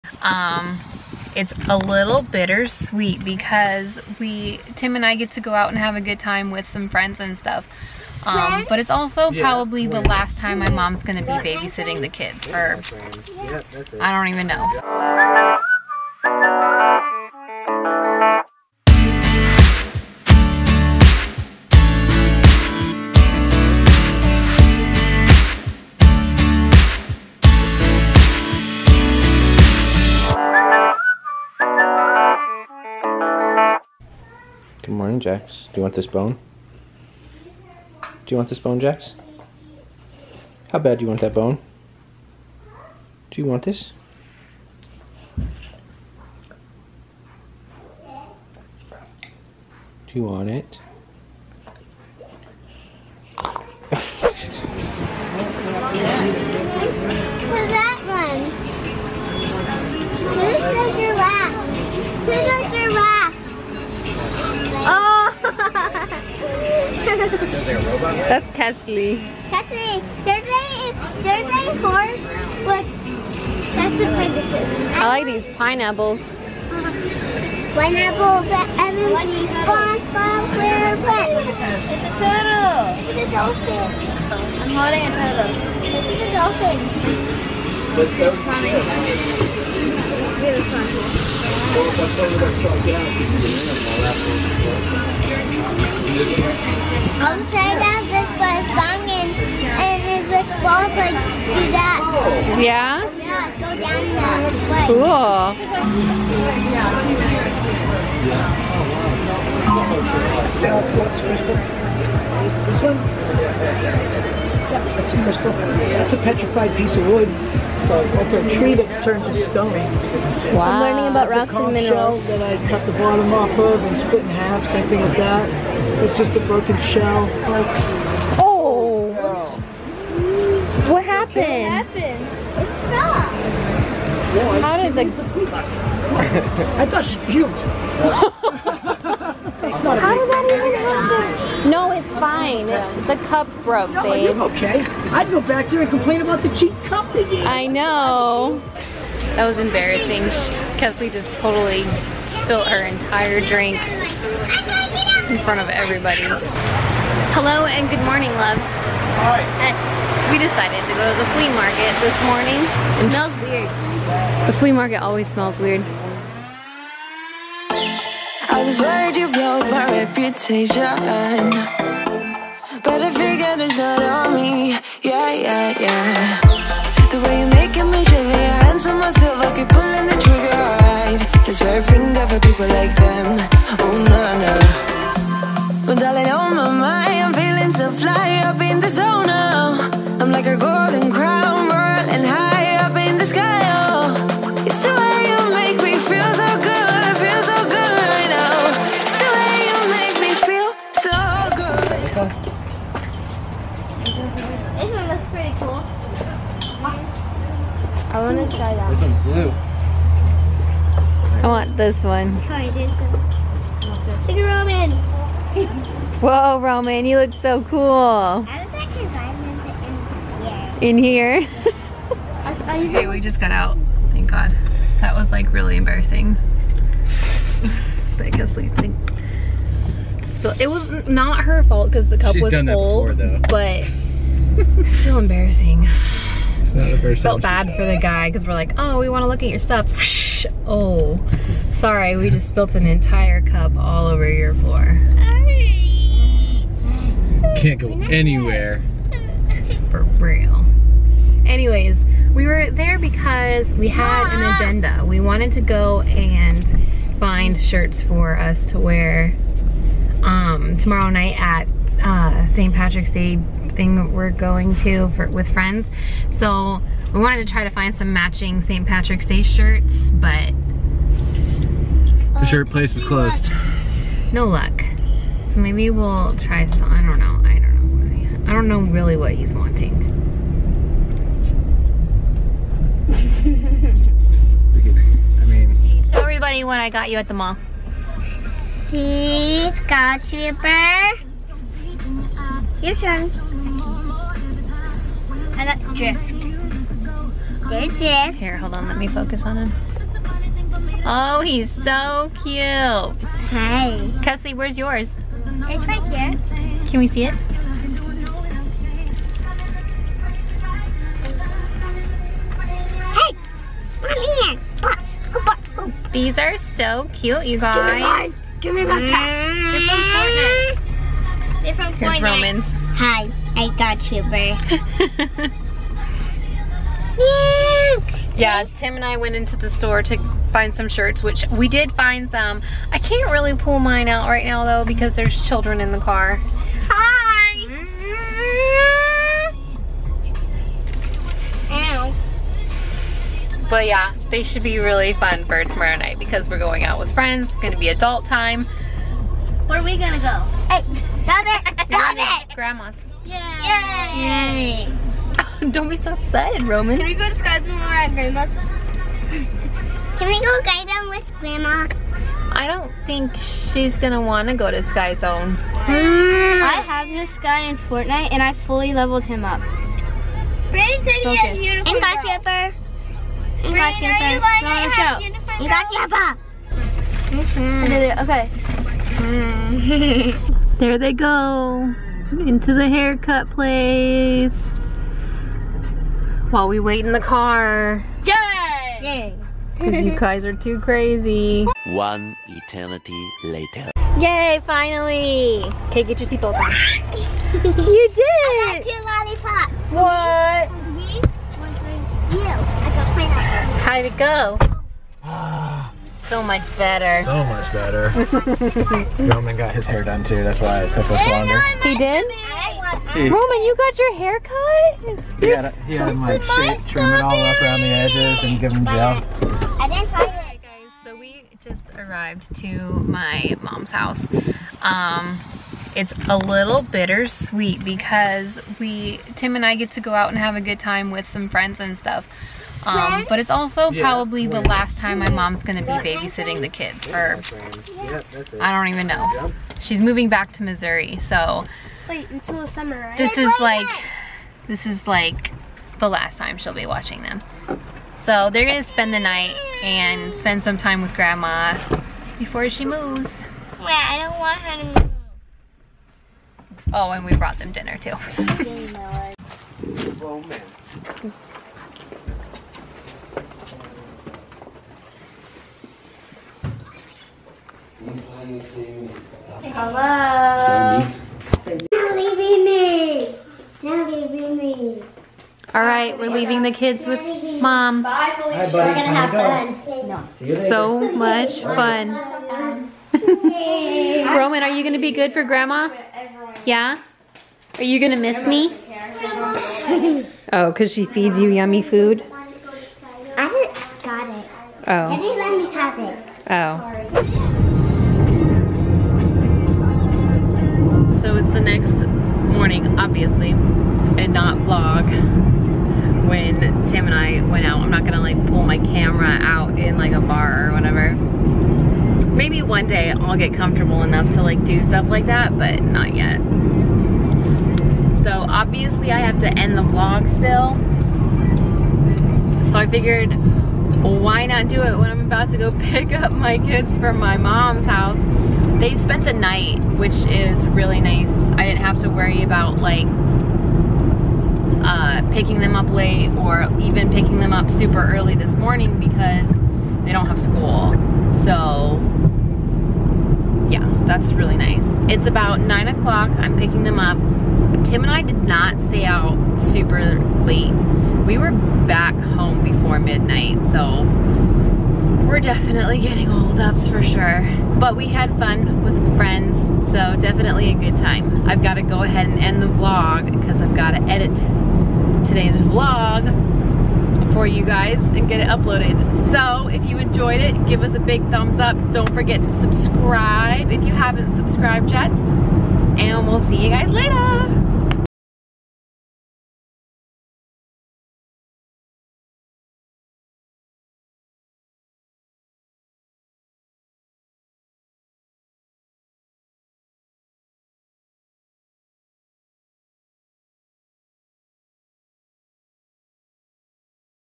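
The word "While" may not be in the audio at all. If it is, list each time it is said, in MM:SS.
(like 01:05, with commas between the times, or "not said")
06:26.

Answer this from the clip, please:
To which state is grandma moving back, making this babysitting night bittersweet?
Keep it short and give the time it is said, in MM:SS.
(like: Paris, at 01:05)
Missouri, at 07:20.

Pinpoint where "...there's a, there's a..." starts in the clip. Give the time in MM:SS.
01:10.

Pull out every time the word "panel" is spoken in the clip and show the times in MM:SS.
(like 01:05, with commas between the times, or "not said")
not said.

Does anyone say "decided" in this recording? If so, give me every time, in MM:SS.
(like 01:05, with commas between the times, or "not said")
02:40.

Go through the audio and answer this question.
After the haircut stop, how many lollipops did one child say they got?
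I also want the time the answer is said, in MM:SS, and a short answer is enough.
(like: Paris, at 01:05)
2, at 06:38.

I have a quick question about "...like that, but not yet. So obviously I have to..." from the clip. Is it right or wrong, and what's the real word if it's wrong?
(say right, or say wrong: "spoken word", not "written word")
right.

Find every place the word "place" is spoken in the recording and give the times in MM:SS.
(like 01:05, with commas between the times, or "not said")
04:32, 06:23.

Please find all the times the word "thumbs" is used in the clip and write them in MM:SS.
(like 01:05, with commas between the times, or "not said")
09:31.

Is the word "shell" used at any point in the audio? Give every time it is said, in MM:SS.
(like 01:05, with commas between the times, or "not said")
02:02, 02:06.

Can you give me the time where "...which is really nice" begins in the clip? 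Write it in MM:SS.
08:49.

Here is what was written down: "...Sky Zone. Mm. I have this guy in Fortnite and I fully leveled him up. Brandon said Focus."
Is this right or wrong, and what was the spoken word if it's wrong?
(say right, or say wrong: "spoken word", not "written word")
right.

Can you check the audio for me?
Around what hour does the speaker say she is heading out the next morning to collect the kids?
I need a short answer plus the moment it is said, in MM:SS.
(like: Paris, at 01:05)
9 o'clock, at 09:05.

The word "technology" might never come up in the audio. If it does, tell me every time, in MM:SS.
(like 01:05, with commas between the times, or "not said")
not said.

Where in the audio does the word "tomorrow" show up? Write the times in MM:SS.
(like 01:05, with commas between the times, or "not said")
04:20, 05:45.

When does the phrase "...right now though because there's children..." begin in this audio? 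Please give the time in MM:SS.
05:34.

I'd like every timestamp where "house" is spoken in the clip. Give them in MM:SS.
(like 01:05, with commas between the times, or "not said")
07:03, 08:47.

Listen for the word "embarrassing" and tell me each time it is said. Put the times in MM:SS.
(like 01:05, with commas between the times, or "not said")
02:29, 03:45, 03:55.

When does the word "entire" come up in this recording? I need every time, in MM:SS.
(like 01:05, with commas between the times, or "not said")
02:32, 04:02.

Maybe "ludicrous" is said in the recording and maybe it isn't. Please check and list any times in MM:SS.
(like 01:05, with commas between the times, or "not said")
not said.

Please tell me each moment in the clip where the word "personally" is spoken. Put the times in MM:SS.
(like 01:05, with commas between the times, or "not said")
not said.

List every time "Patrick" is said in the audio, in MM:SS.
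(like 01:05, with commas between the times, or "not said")
04:22, 04:28.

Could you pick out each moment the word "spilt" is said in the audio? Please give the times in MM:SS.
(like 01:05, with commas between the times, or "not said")
02:32, 04:02.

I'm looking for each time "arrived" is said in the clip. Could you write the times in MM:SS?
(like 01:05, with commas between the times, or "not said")
07:01.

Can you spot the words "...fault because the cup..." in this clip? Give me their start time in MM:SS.
03:51.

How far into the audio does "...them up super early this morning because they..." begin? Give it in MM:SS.
08:57.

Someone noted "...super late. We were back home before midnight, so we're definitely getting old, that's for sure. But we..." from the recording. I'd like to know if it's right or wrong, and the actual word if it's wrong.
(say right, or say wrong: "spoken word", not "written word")
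right.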